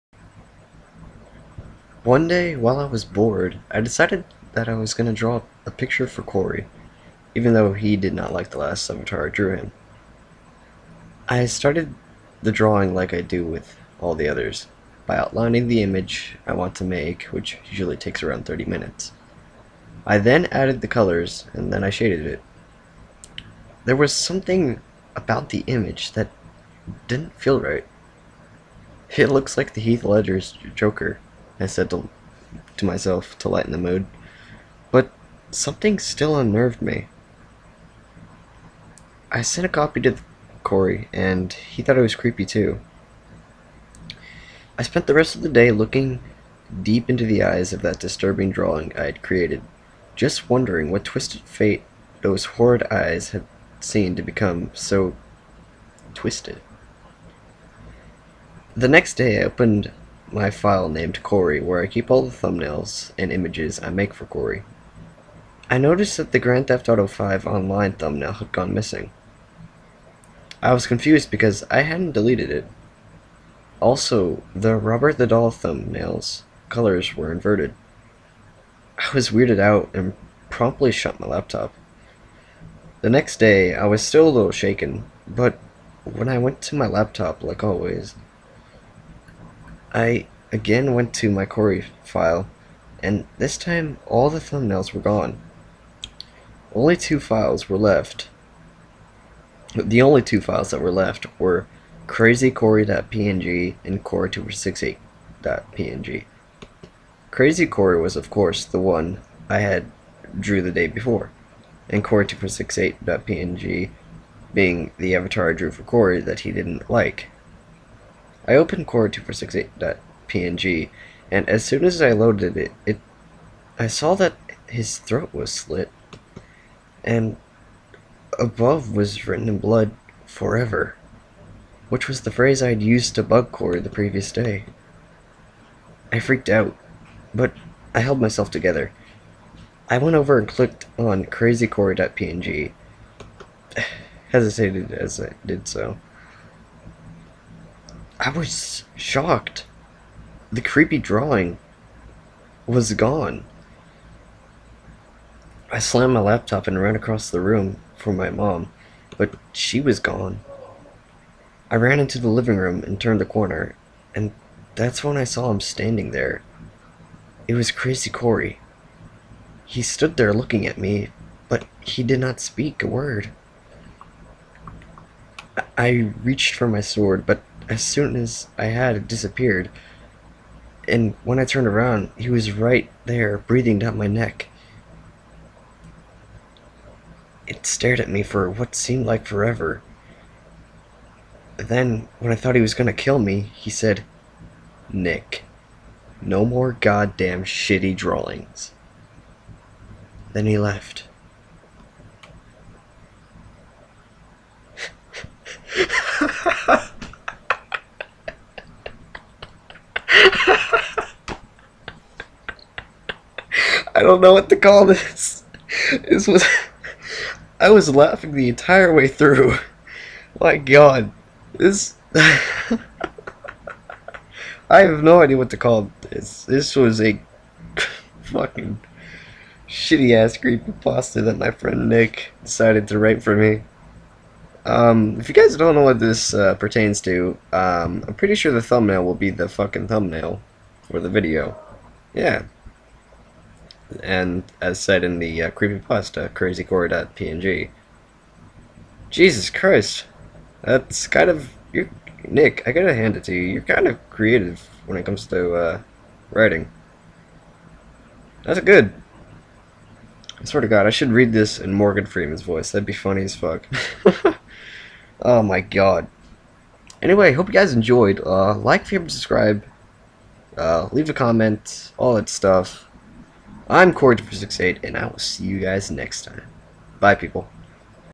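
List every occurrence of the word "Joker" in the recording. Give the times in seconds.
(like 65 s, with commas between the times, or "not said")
30 s.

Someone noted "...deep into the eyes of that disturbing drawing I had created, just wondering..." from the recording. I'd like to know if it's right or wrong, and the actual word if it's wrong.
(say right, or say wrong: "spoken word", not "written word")
right.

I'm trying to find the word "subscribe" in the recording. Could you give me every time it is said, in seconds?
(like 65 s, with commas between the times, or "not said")
269 s.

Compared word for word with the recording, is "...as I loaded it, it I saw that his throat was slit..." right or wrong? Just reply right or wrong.
right.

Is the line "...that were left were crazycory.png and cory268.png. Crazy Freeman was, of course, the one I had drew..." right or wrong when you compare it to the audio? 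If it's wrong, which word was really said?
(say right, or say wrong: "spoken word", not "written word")
wrong: "Cory", not "Freeman".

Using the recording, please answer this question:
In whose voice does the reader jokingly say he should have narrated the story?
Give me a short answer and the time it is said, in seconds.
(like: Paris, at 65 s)
Morgan Freeman, at 261 s.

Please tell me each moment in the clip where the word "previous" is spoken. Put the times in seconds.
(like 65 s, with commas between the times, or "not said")
133 s.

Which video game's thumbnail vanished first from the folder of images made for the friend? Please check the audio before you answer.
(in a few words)
Grand Theft Auto 5.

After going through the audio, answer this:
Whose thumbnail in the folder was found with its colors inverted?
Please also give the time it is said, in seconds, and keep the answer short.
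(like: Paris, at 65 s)
Robert the Doll, at 74 s.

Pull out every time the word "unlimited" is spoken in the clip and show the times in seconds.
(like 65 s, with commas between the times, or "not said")
not said.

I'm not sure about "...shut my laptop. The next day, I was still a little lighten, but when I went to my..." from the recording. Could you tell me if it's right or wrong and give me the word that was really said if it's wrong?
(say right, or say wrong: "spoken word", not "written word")
wrong: "shaken", not "lighten".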